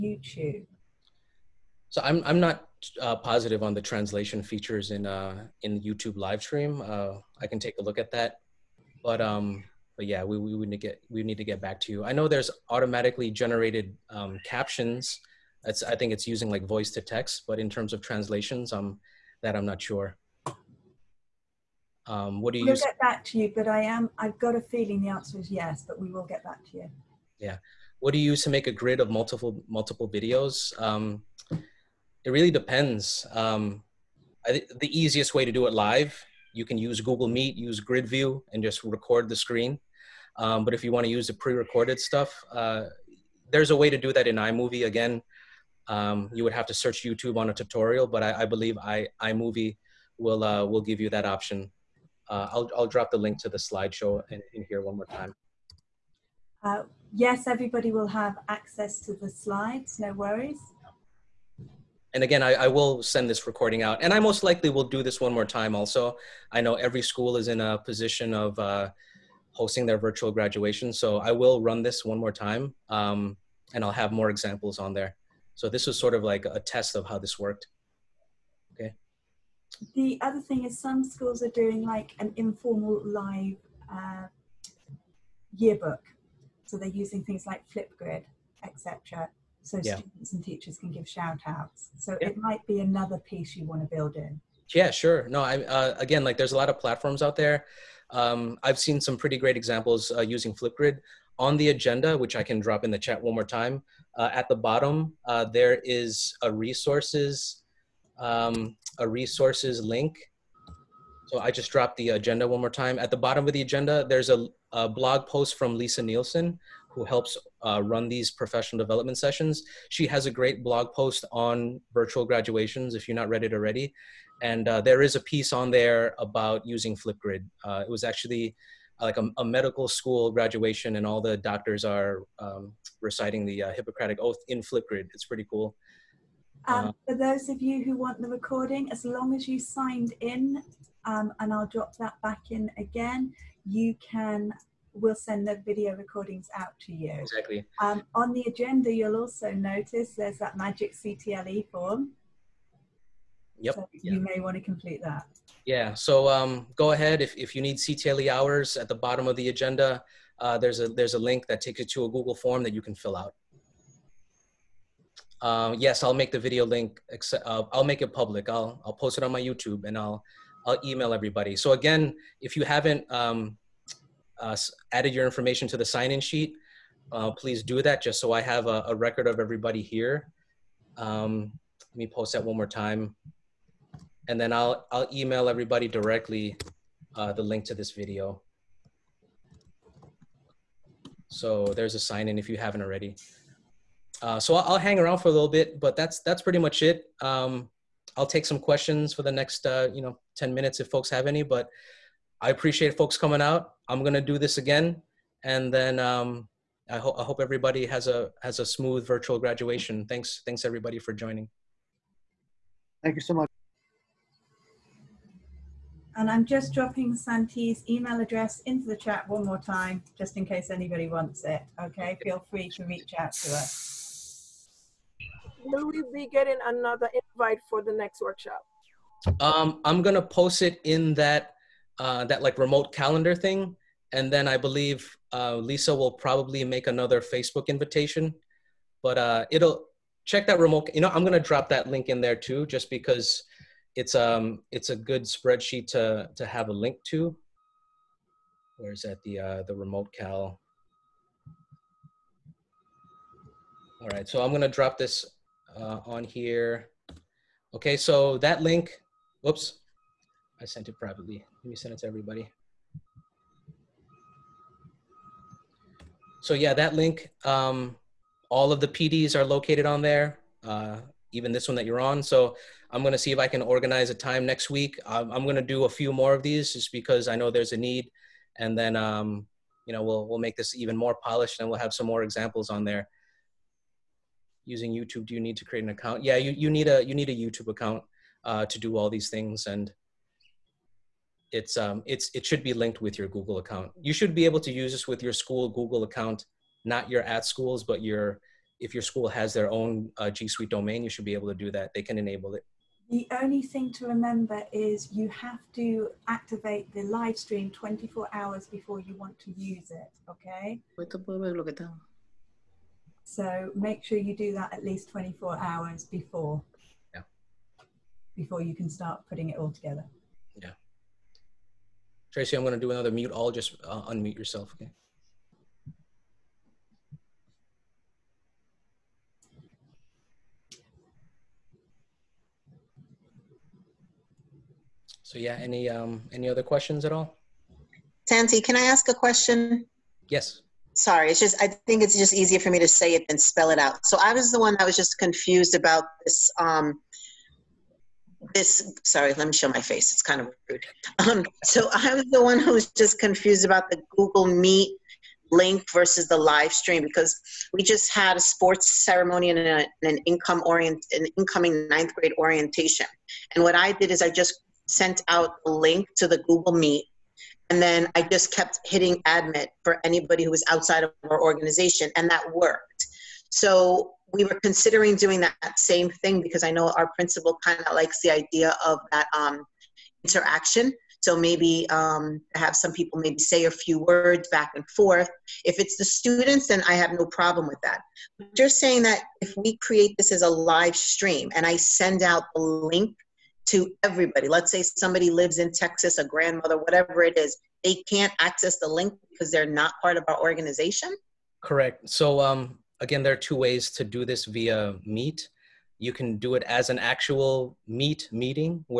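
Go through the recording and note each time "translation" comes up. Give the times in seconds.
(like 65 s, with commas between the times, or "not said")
3 s, 17 s.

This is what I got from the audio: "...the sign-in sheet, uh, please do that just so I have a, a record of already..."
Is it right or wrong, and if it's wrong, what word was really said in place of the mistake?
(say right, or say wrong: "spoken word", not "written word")
wrong: "everybody", not "already".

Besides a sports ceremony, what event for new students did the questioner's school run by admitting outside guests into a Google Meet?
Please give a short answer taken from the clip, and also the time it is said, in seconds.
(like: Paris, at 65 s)
ninth grade orientation, at 361 s.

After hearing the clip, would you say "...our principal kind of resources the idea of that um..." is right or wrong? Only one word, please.
wrong.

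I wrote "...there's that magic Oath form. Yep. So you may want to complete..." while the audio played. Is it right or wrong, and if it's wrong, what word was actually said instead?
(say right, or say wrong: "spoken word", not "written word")
wrong: "CTLE", not "Oath".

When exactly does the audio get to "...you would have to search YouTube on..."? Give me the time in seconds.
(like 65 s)
46 s.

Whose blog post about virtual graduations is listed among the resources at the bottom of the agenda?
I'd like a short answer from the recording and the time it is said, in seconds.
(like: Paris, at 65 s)
Lisa Nielsen, at 115 s.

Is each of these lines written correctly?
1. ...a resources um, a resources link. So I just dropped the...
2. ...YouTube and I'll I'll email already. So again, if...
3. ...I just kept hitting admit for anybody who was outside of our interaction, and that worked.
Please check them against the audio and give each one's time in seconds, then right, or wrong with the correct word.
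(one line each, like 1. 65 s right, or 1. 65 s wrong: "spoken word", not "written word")
1. 106 s right
2. 169 s wrong: "everybody", not "already"
3. 368 s wrong: "organization", not "interaction".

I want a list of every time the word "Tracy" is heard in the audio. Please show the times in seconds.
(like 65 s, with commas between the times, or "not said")
322 s.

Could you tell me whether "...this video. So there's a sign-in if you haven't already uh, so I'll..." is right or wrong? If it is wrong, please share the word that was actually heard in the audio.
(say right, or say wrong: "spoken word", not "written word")
right.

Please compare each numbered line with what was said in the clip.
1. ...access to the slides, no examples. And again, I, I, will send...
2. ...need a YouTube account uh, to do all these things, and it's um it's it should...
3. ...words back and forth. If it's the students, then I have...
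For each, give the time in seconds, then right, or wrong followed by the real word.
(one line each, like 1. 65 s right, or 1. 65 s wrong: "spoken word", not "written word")
1. 58 s wrong: "worries", not "examples"
2. 287 s right
3. 383 s right.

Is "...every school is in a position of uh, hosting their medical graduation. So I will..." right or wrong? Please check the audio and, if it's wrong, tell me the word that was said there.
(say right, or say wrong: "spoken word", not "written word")
wrong: "virtual", not "medical".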